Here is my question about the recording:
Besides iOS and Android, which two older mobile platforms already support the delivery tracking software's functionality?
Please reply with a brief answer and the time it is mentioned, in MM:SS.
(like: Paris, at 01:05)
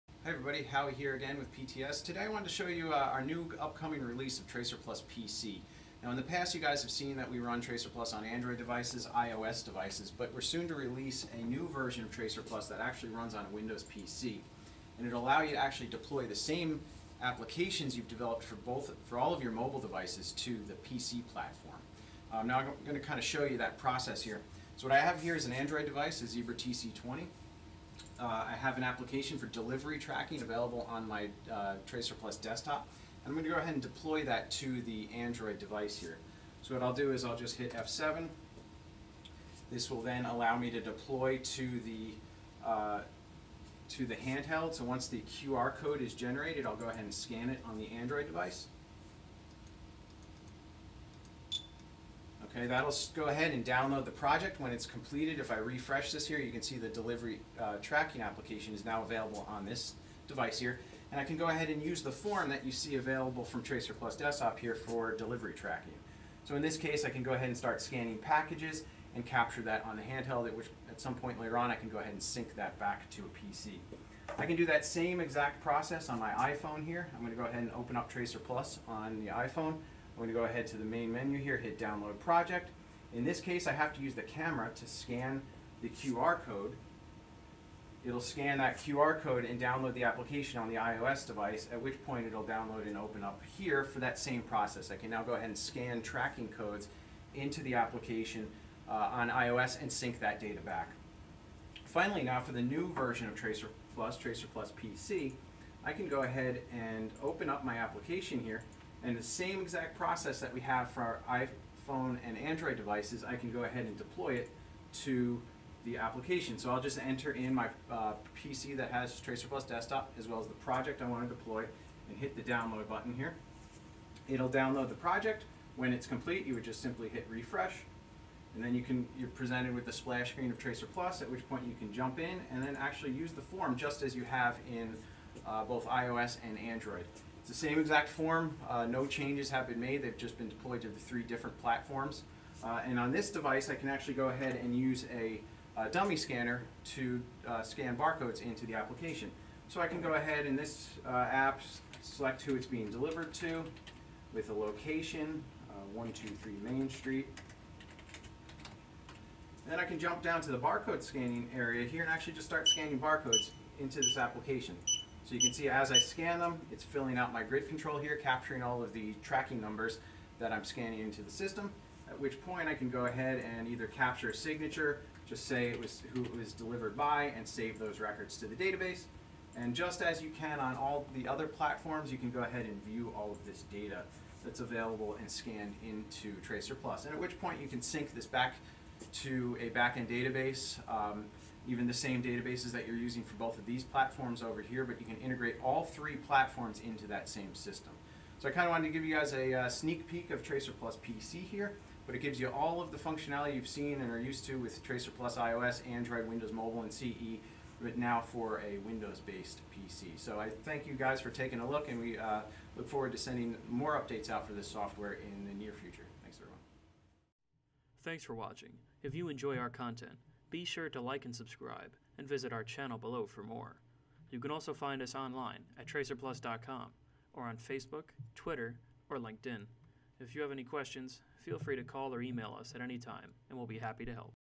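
Windows Mobile and CE, at 03:26.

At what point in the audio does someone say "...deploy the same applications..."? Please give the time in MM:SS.
00:15.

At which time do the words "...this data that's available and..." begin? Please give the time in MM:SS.
03:03.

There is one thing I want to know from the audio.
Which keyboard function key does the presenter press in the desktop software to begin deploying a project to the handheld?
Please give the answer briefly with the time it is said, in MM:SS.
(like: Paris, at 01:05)
F7, at 00:37.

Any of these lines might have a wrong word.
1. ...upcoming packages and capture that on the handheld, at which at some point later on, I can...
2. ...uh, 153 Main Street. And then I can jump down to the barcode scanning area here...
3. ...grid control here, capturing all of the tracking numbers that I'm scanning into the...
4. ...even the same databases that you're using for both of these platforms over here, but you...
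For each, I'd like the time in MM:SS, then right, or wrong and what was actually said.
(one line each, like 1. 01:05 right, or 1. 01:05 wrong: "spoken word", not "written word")
1. 01:07 wrong: "scanning", not "upcoming"
2. 02:35 wrong: "123", not "153"
3. 02:47 right
4. 03:11 right.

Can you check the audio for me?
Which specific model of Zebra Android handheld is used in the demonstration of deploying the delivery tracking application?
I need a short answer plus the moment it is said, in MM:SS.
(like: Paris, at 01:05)
TC20, at 00:26.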